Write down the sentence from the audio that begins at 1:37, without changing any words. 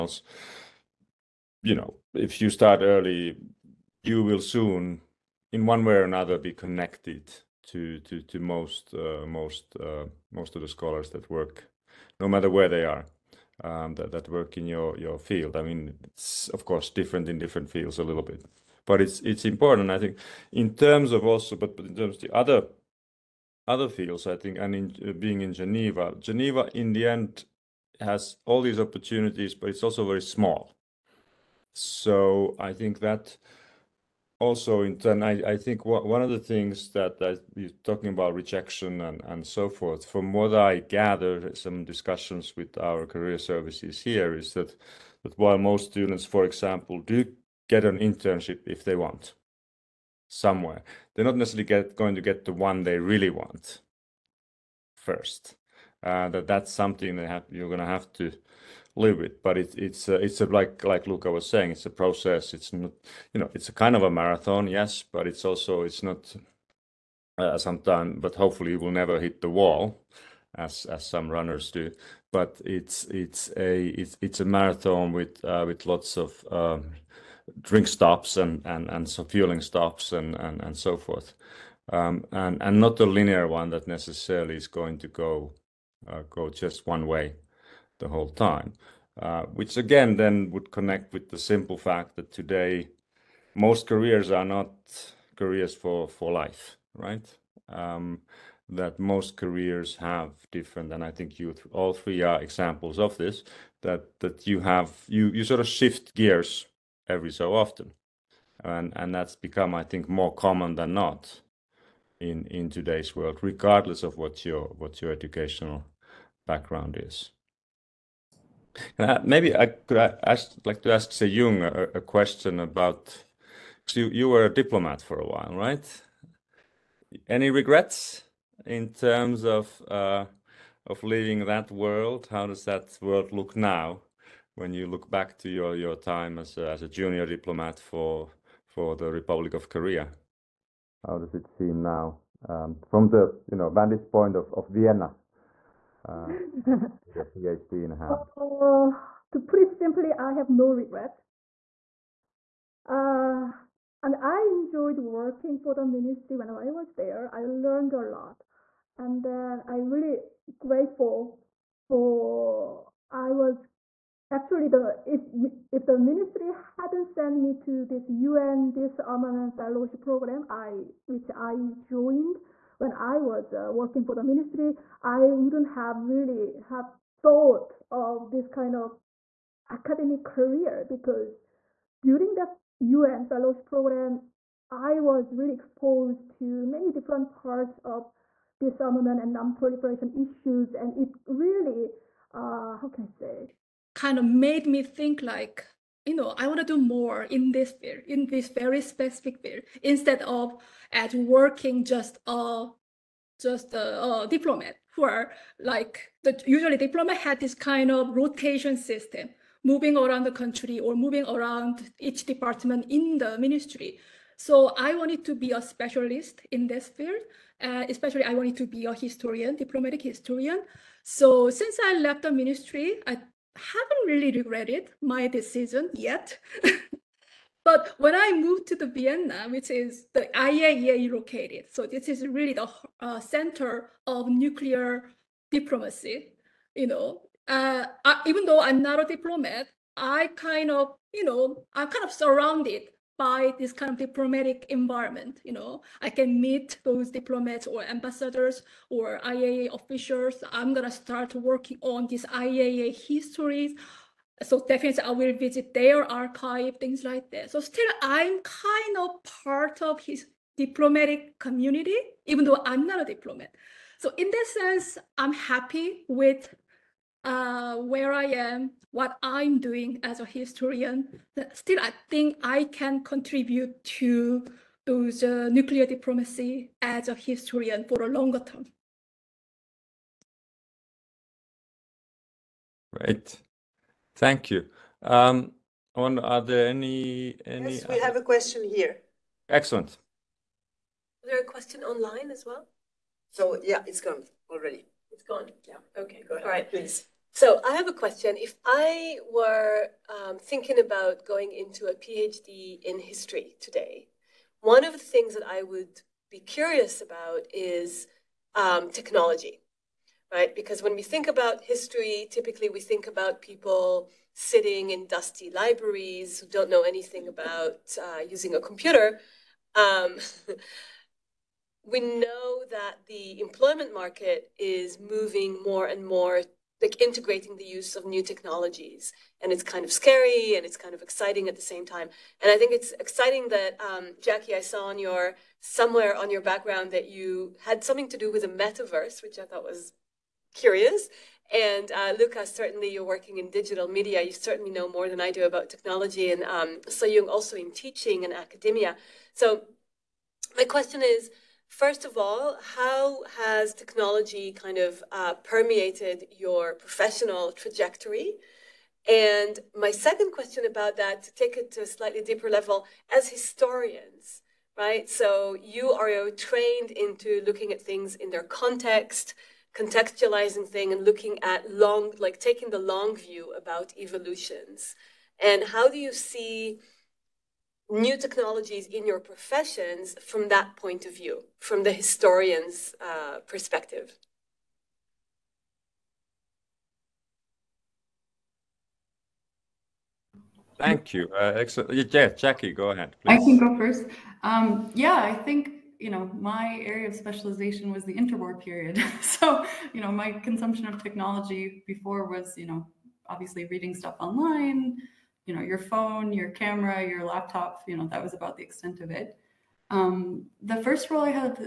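Um, that most careers have different, and I think you all three are examples of this.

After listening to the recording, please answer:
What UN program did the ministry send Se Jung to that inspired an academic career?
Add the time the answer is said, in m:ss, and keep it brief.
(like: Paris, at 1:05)
UN disarmament fellowship program, at 2:48.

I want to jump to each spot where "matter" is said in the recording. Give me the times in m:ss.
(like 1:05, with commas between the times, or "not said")
0:12.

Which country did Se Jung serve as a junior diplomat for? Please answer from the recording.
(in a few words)
Republic of Korea.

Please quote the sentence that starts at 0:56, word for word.
Uh, that that's something that have, you're going to have to live with.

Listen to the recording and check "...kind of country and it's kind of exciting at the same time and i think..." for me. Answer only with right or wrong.
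wrong.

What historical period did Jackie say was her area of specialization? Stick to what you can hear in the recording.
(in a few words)
The interwar period.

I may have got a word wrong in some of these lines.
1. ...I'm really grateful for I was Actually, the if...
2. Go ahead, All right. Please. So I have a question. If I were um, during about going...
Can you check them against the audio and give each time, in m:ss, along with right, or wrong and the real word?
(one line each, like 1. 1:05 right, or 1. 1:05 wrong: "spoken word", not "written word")
1. 2:39 right
2. 4:56 wrong: "thinking", not "during".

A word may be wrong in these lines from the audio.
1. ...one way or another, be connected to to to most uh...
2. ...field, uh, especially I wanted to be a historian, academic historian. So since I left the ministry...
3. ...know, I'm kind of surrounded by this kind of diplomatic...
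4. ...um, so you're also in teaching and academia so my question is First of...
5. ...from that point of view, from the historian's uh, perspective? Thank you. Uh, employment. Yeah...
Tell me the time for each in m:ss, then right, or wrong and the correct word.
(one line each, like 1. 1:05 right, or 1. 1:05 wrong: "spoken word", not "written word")
1. 0:05 right
2. 3:36 wrong: "diplomatic", not "academic"
3. 4:01 right
4. 5:46 right
5. 6:20 wrong: "excellent", not "employment".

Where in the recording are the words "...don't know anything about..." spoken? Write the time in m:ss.
5:16.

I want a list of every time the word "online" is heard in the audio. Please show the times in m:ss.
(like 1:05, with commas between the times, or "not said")
4:51, 6:44.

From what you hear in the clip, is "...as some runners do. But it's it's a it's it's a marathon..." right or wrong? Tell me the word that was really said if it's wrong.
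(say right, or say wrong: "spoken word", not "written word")
right.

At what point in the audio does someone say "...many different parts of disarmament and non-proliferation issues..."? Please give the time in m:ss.
3:06.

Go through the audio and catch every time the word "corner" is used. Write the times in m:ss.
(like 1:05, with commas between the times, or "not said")
not said.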